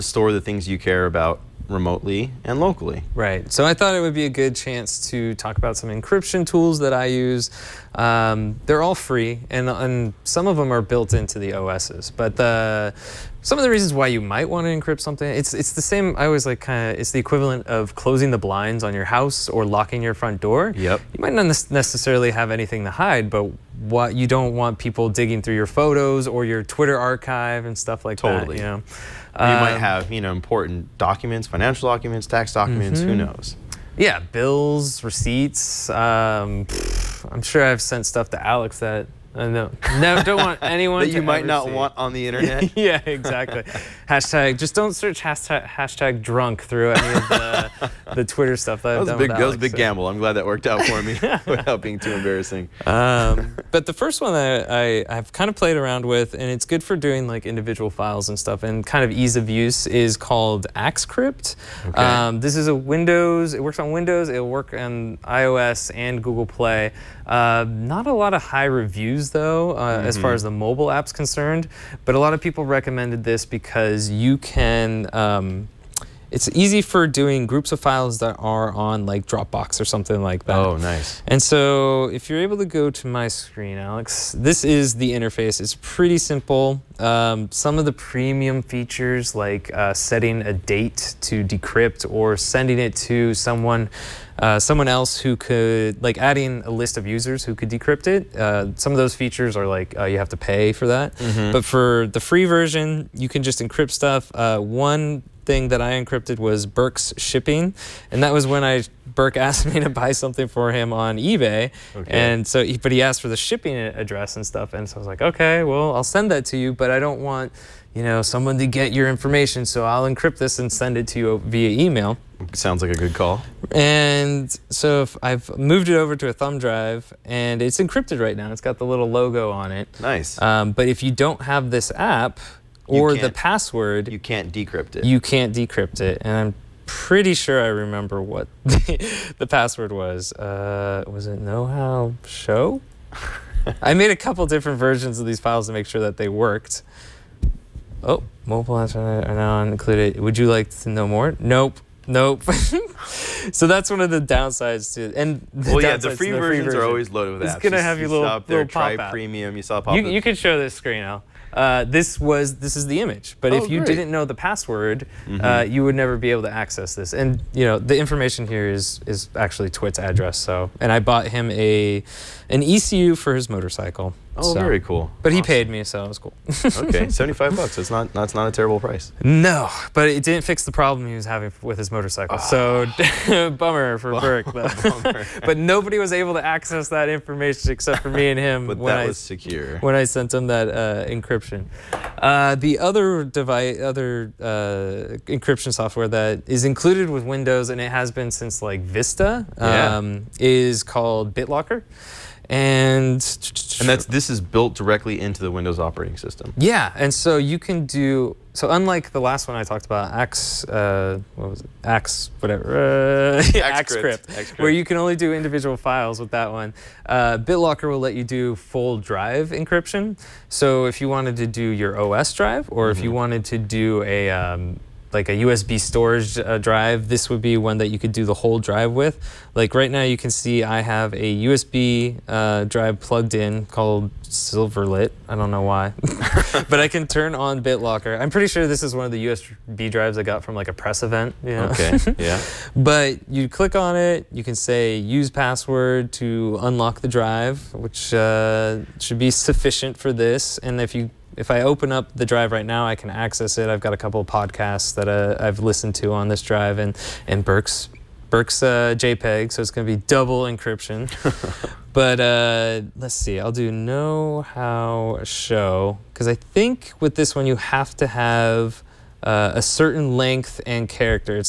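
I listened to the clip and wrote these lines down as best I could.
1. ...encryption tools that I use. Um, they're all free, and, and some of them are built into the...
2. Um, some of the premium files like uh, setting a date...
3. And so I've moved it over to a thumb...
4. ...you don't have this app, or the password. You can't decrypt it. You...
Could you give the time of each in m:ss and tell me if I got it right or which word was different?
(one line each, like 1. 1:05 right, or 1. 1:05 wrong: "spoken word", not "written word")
1. 0:05 right
2. 1:26 wrong: "features", not "files"
3. 2:03 right
4. 2:11 right.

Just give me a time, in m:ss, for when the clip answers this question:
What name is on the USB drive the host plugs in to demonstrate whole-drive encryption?
3:54.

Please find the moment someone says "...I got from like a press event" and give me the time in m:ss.
4:00.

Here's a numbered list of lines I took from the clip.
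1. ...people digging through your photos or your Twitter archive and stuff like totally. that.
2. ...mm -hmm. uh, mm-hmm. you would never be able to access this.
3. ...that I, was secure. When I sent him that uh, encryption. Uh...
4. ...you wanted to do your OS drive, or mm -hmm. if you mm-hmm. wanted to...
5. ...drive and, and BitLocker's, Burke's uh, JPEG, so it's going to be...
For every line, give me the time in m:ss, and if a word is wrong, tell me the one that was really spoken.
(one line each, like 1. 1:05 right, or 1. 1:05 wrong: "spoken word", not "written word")
1. 0:24 right
2. 2:45 right
3. 3:08 right
4. 3:40 right
5. 4:16 wrong: "Burke", not "BitLocker".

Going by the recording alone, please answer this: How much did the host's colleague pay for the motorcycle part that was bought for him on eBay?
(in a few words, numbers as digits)
$75.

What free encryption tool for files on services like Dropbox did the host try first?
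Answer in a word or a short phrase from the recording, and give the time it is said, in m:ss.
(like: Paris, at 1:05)
AxCrypt, at 1:00.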